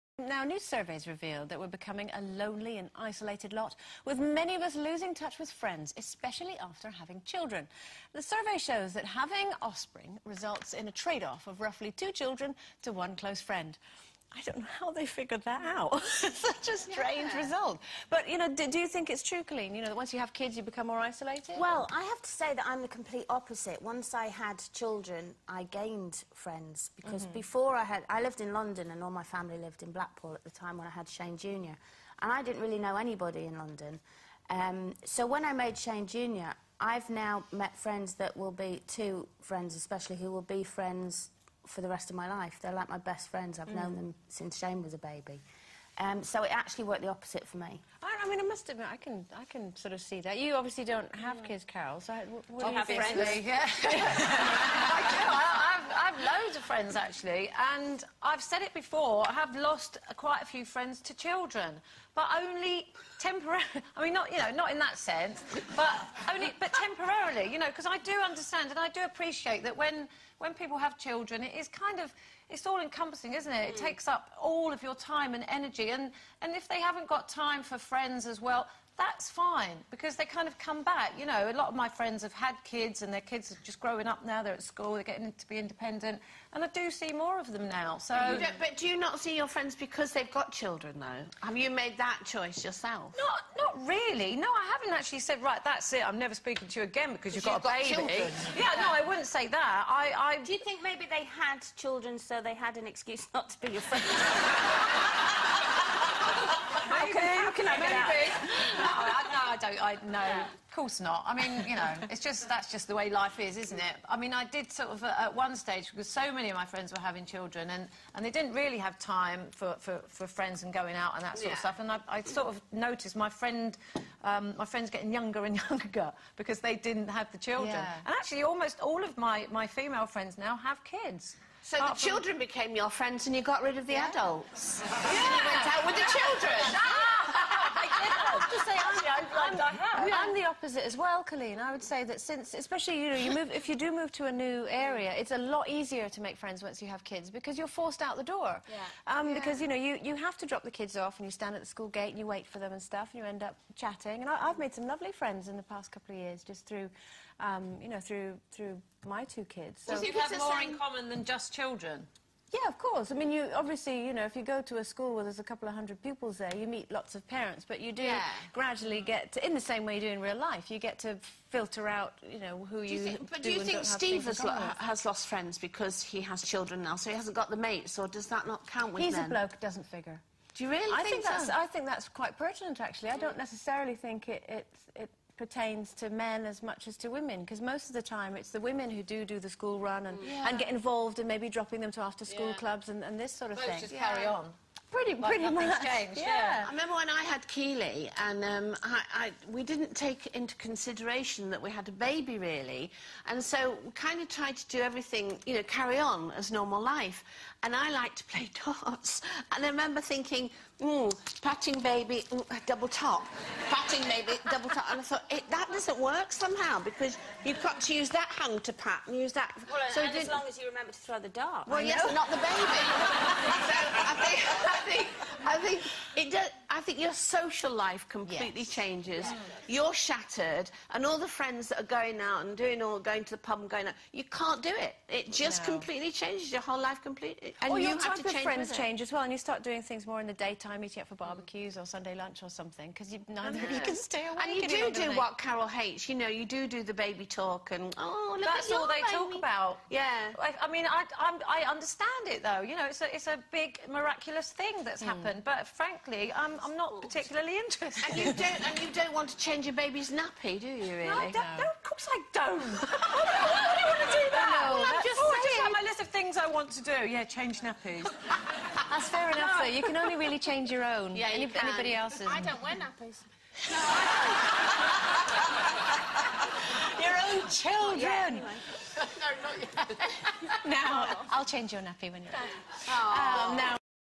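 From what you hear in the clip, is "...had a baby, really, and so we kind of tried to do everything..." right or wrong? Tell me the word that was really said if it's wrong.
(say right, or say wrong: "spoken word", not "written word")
right.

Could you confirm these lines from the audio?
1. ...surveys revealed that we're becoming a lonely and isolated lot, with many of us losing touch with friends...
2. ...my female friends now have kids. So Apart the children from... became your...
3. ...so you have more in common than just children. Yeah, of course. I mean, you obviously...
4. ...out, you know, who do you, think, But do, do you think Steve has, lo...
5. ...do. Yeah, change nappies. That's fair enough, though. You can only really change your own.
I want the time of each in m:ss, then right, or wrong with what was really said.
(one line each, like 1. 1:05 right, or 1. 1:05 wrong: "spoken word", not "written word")
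1. 0:00 right
2. 2:09 right
3. 2:39 right
4. 2:51 right
5. 4:26 right.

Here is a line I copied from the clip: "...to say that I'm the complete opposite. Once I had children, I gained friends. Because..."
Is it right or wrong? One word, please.
right.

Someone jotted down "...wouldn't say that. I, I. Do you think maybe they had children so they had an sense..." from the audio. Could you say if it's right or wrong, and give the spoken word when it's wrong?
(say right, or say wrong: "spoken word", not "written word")
wrong: "excuse", not "sense".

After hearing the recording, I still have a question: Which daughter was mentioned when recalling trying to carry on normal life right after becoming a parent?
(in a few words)
Keeley.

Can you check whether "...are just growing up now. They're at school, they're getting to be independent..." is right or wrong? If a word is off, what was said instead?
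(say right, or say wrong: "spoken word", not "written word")
right.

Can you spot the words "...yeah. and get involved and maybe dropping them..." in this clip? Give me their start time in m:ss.
3:10.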